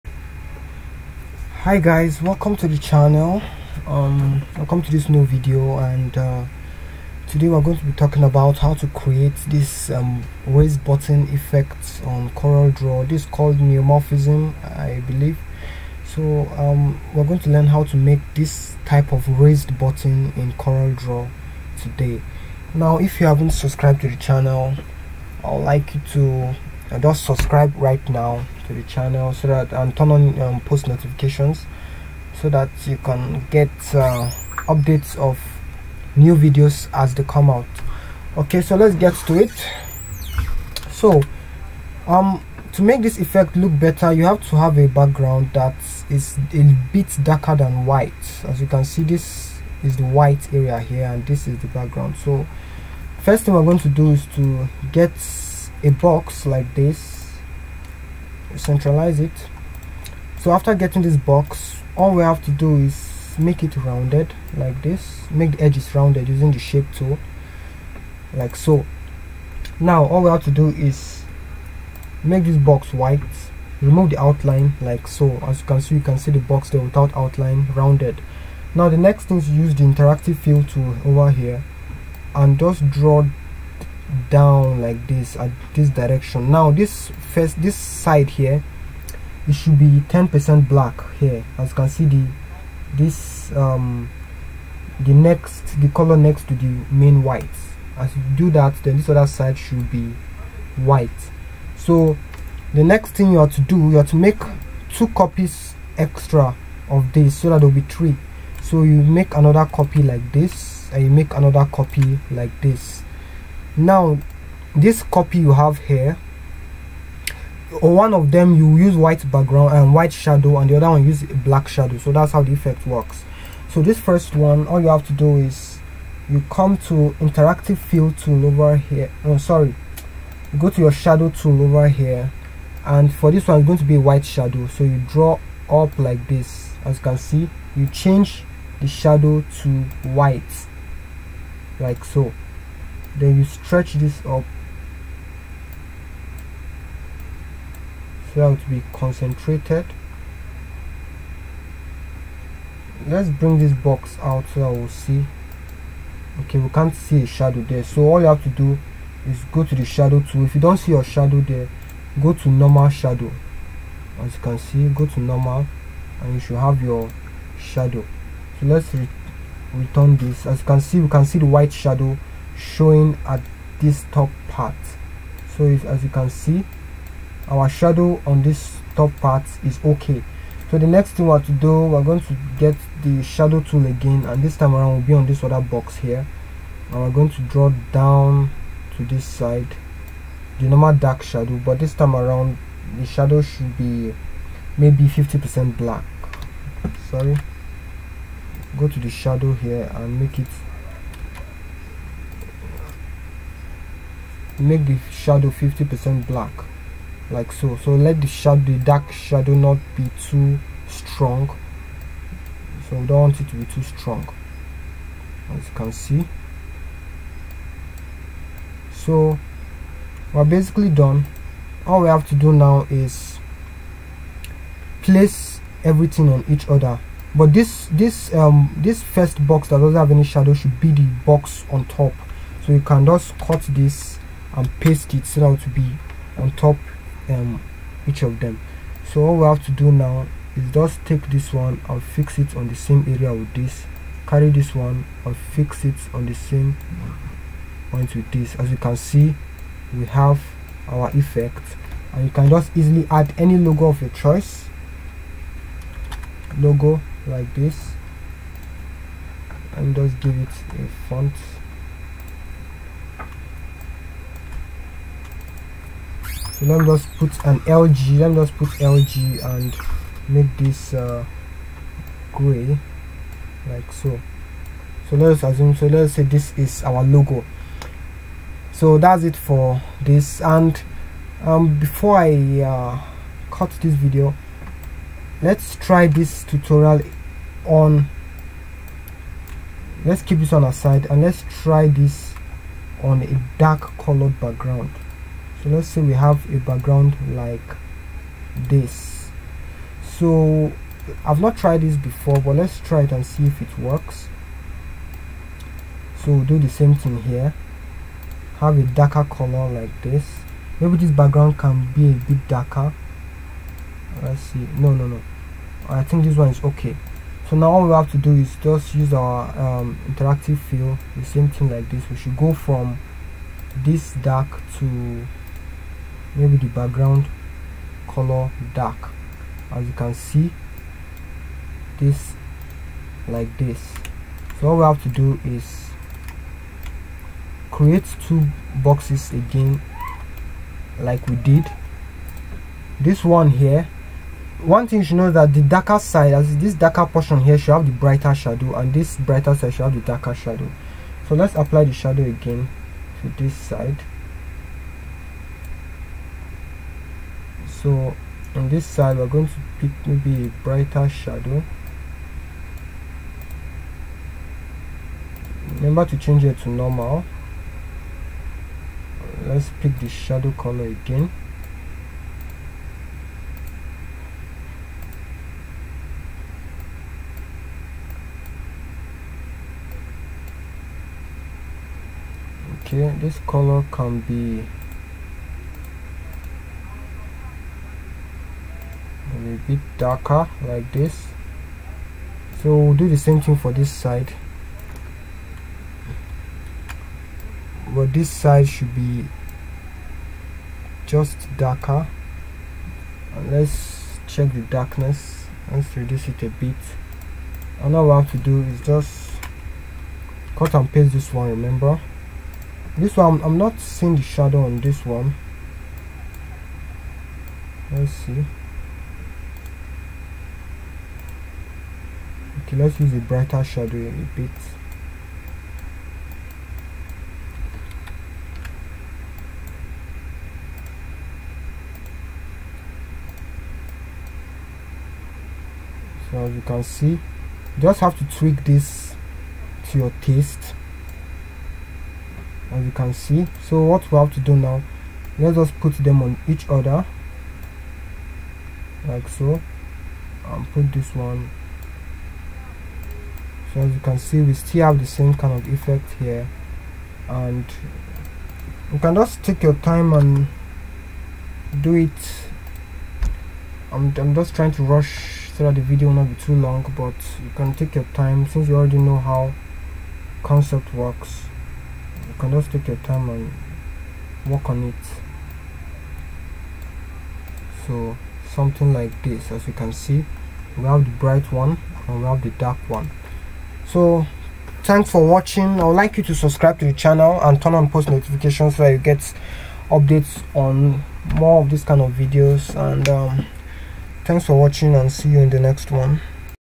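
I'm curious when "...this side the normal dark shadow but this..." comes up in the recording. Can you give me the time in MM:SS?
03:09.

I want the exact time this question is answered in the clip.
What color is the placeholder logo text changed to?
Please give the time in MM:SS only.
04:32.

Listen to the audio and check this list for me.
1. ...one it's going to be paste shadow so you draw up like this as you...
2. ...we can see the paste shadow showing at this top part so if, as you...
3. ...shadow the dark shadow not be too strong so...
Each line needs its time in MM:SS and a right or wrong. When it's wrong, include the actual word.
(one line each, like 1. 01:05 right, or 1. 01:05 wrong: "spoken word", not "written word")
1. 02:13 wrong: "white", not "paste"
2. 02:50 wrong: "white", not "paste"
3. 03:28 right.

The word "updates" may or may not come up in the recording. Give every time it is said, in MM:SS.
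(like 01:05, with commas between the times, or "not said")
00:34, 08:09.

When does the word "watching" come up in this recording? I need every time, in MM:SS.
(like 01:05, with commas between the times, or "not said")
08:05, 08:14.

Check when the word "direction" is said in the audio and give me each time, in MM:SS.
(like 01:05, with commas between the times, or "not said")
01:25.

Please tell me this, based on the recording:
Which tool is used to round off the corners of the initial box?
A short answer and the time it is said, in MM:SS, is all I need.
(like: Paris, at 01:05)
Shape tool, at 01:06.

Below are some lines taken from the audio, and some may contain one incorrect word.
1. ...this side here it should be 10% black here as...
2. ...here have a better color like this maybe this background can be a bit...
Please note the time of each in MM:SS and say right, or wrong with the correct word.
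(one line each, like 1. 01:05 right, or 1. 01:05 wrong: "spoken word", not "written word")
1. 01:27 right
2. 05:07 wrong: "darker", not "better".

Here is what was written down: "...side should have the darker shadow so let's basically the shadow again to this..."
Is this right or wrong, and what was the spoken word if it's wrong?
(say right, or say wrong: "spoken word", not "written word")
wrong: "apply", not "basically".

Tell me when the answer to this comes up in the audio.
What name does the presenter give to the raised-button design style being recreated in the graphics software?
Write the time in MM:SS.
00:13.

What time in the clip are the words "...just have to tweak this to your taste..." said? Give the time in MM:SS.
07:17.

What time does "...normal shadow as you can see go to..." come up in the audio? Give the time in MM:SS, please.
02:42.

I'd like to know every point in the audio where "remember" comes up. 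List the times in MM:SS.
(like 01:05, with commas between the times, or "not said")
06:05, 06:51.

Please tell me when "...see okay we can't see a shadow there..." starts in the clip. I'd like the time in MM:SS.
02:34.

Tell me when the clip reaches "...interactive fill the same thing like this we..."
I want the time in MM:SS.
05:20.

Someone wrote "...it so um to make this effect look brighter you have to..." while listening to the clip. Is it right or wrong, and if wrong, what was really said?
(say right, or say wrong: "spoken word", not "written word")
wrong: "better", not "brighter".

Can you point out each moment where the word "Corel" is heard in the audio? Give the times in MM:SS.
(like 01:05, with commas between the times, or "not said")
00:12, 00:20.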